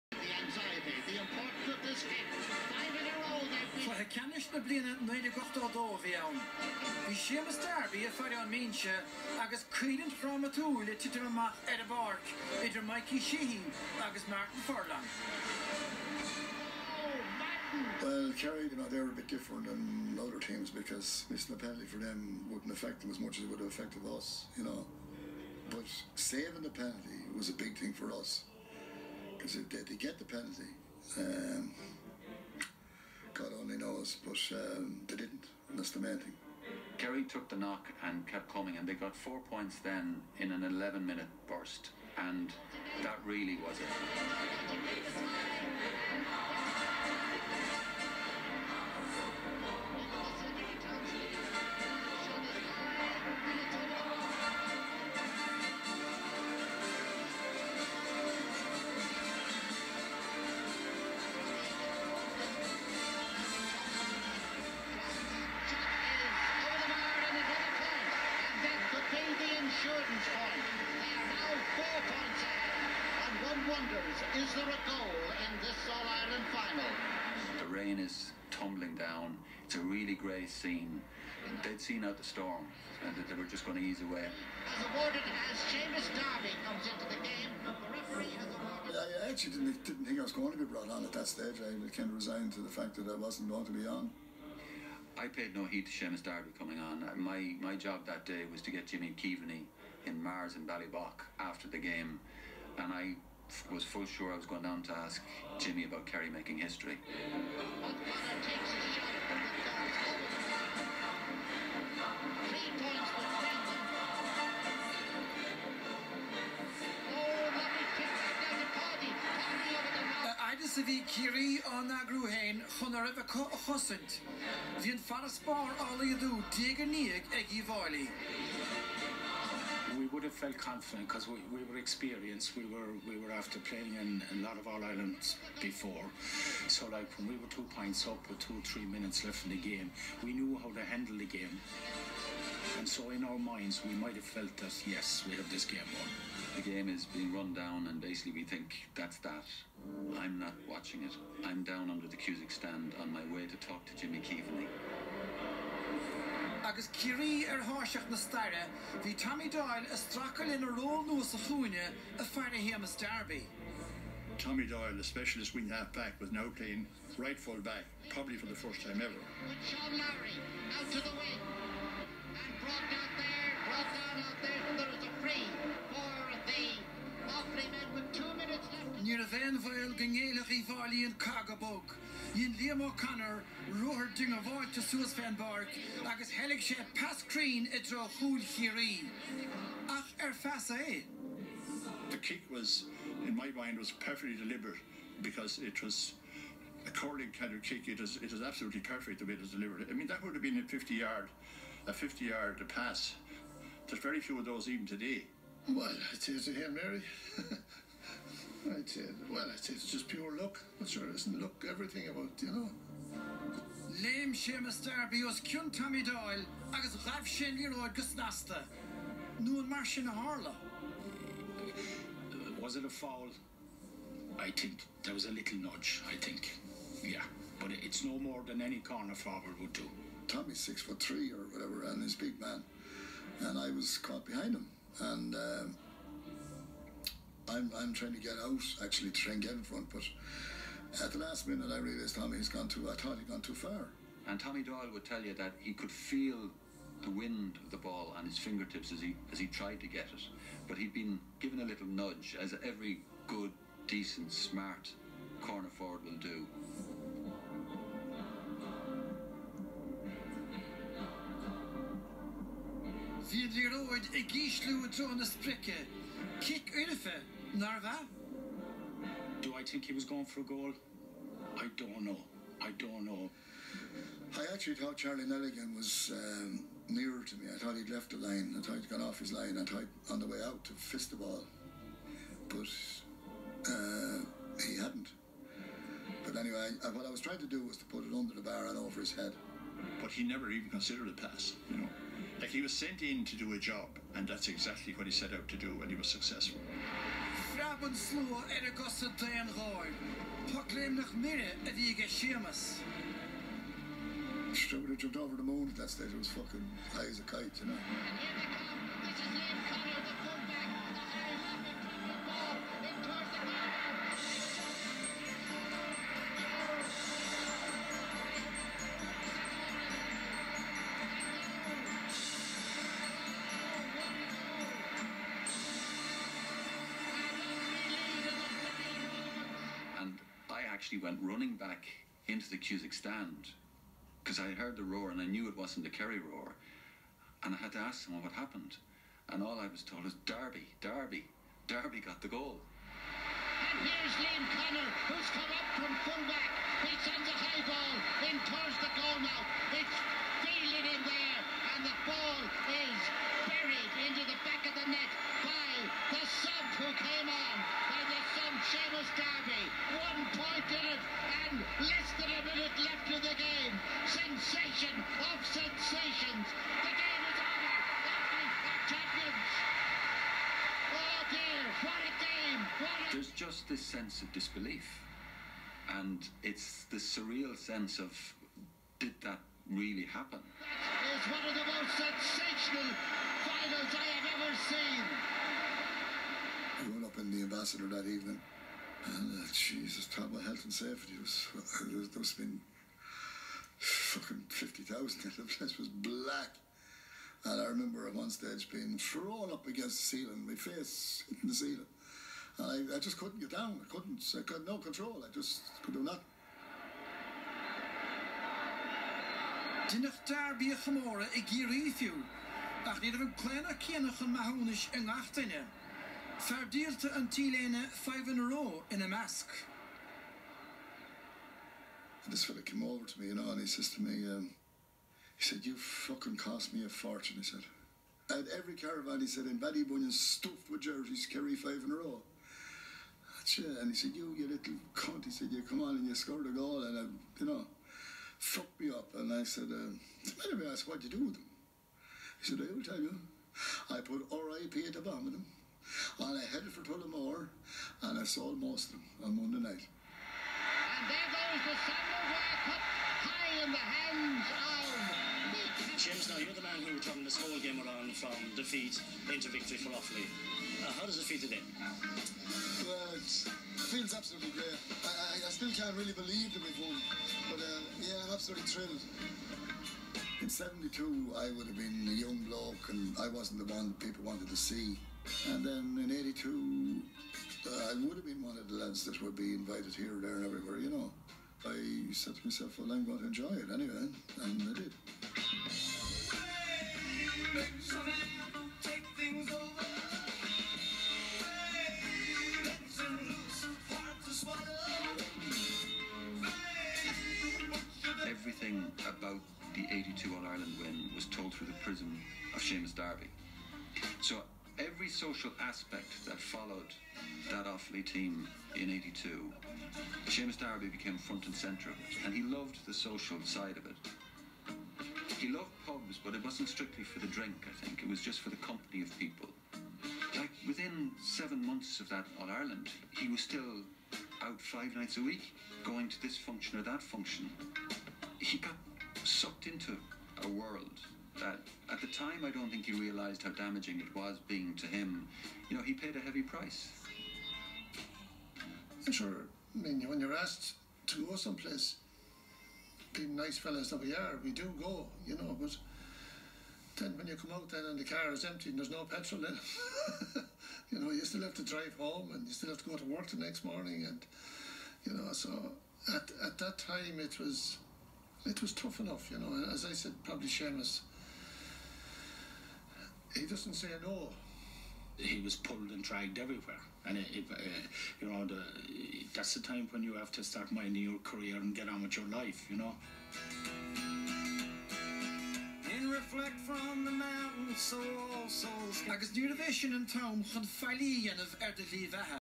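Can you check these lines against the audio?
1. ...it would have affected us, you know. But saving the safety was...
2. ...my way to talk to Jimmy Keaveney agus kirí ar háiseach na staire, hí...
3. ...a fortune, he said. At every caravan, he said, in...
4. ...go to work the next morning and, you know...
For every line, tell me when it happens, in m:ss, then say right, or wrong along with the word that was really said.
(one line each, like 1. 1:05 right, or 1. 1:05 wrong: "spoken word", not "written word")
1. 0:23 wrong: "penalty", not "safety"
2. 2:33 right
3. 7:06 right
4. 9:12 right.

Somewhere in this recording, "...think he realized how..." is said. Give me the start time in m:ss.
8:52.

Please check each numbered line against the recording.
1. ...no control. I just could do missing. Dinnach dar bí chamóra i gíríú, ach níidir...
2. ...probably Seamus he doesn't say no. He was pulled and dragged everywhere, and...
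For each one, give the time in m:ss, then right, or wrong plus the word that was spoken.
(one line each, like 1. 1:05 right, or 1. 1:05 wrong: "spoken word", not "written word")
1. 6:44 wrong: "nothing", not "missing"
2. 9:20 right.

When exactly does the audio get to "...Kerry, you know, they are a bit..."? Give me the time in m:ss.
0:18.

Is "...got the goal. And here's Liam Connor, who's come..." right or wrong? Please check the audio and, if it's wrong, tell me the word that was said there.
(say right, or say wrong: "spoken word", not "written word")
right.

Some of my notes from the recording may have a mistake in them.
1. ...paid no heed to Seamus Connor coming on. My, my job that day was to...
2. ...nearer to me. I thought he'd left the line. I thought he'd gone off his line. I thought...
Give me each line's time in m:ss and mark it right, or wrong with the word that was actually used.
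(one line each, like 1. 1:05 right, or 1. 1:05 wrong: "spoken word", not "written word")
1. 1:35 wrong: "Darby", not "Connor"
2. 4:36 right.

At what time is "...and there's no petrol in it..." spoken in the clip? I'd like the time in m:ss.
9:08.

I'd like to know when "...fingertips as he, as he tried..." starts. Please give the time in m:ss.
4:08.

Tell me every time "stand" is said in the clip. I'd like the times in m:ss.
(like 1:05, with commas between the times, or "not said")
2:32, 5:32.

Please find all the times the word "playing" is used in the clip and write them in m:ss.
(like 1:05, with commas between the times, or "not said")
2:13, 2:46.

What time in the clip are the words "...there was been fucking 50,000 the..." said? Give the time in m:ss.
6:31.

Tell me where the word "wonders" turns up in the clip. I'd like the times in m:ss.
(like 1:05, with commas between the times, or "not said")
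1:13.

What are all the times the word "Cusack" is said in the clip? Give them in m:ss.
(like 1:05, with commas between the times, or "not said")
2:32, 5:32.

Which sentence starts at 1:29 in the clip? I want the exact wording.
I actually didn't, didn't think I was going to be brought on at that stage.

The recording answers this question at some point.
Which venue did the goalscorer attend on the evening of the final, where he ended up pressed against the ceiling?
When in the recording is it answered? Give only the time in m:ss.
6:27.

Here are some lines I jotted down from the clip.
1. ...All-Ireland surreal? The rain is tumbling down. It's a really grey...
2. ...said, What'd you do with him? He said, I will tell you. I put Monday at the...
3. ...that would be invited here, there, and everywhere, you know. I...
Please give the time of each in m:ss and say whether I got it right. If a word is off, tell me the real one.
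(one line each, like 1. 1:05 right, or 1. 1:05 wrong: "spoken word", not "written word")
1. 1:15 wrong: "final", not "surreal"
2. 7:20 wrong: "RIP", not "Monday"
3. 7:59 right.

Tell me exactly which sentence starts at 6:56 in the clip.
Ferdíalte an tíléine 5 in a row in a mask.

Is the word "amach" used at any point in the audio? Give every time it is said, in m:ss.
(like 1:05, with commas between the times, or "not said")
0:11.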